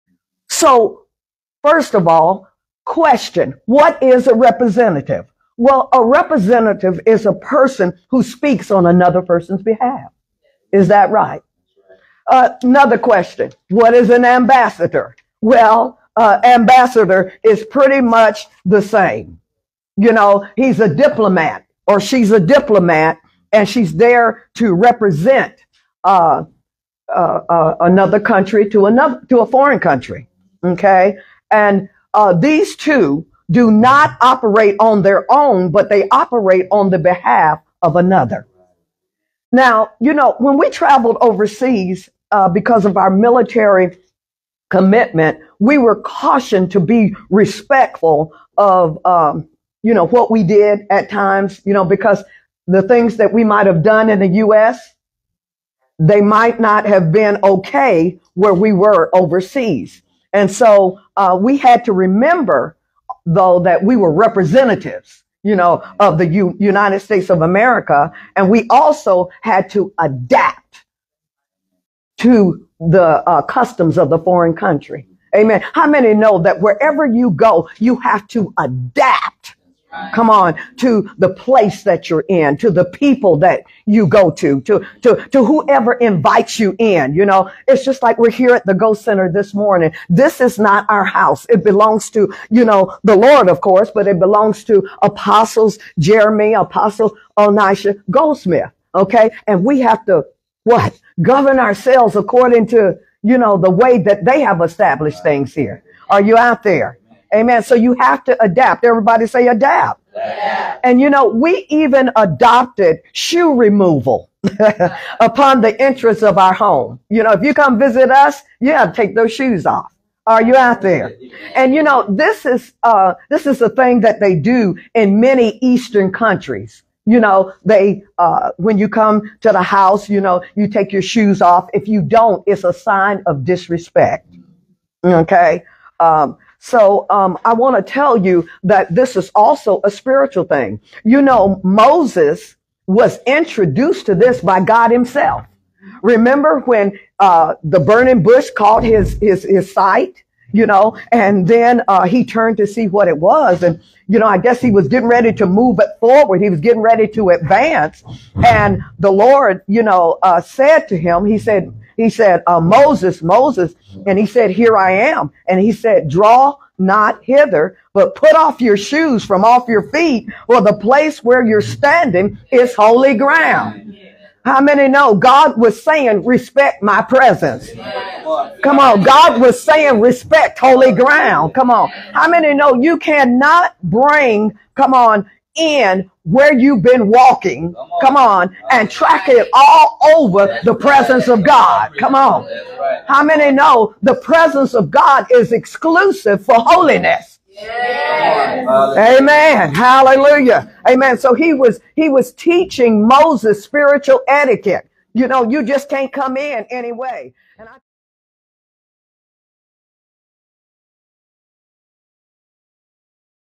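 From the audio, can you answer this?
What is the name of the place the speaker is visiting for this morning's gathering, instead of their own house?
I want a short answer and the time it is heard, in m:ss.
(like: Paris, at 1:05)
Go Center, at 1:28.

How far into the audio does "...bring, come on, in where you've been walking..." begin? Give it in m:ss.
3:03.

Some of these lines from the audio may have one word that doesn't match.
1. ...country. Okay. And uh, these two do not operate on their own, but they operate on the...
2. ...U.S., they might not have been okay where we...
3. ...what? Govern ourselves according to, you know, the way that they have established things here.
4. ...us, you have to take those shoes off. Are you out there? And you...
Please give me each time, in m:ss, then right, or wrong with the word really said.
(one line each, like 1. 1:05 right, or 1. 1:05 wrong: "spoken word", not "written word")
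1. 0:29 right
2. 0:54 right
3. 1:40 right
4. 1:58 right.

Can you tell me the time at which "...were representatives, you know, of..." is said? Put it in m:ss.
1:03.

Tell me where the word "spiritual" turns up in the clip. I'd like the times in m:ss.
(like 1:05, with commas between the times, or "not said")
2:19, 3:23.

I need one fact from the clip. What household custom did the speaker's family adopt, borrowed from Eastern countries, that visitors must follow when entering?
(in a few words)
Shoe removal.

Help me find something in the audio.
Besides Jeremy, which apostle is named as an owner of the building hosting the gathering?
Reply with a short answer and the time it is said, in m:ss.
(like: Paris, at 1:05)
Onisha Goldsmith, at 1:37.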